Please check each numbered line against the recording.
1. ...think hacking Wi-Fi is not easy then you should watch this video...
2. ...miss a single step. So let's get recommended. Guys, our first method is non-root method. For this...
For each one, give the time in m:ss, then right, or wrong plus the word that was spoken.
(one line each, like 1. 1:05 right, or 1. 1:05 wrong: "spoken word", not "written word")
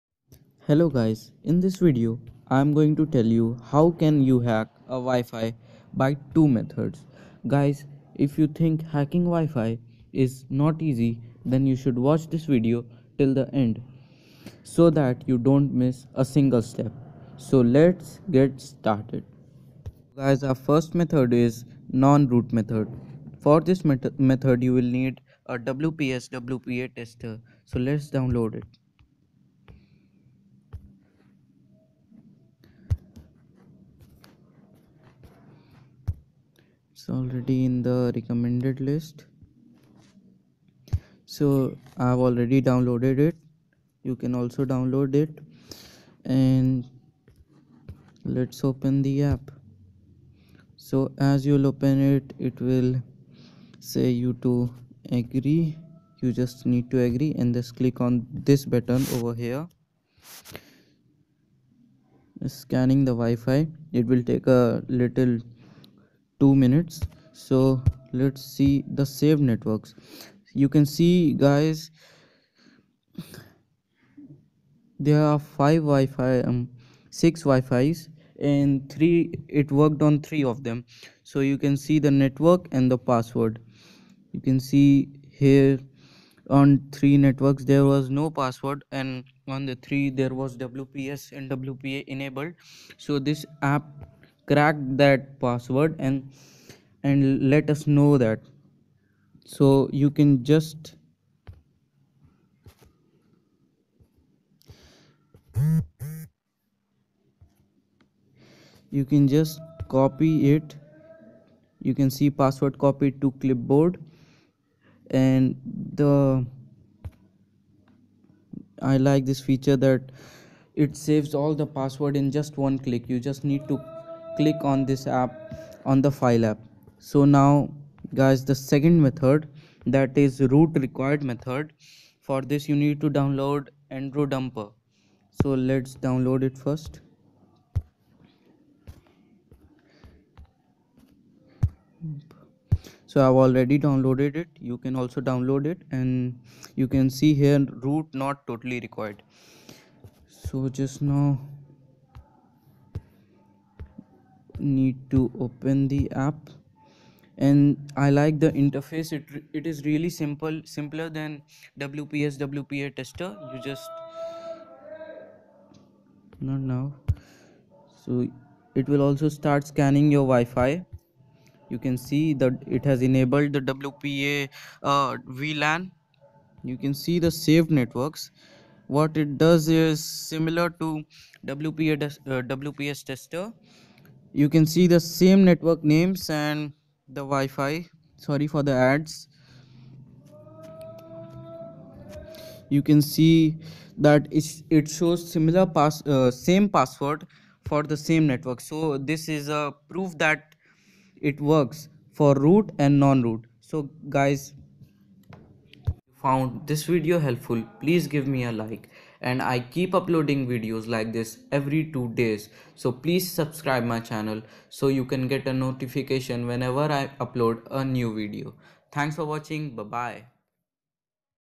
1. 0:08 right
2. 0:15 wrong: "started", not "recommended".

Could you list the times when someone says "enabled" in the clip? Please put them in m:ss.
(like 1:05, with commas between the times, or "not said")
1:32, 2:53.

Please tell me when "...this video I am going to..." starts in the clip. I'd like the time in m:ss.
0:01.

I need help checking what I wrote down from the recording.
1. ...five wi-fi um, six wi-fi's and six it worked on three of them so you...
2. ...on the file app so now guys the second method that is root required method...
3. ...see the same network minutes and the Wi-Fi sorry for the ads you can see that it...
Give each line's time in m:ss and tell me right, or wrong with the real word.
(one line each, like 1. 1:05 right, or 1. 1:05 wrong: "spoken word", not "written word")
1. 1:15 wrong: "three", not "six"
2. 2:05 right
3. 3:04 wrong: "names", not "minutes".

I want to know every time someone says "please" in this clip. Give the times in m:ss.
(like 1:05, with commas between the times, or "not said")
3:27, 3:32.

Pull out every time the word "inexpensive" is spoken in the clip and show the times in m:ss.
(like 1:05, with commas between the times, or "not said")
not said.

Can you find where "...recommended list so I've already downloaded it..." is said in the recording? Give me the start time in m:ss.
0:38.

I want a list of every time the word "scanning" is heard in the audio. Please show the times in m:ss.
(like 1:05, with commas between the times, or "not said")
1:02, 2:49.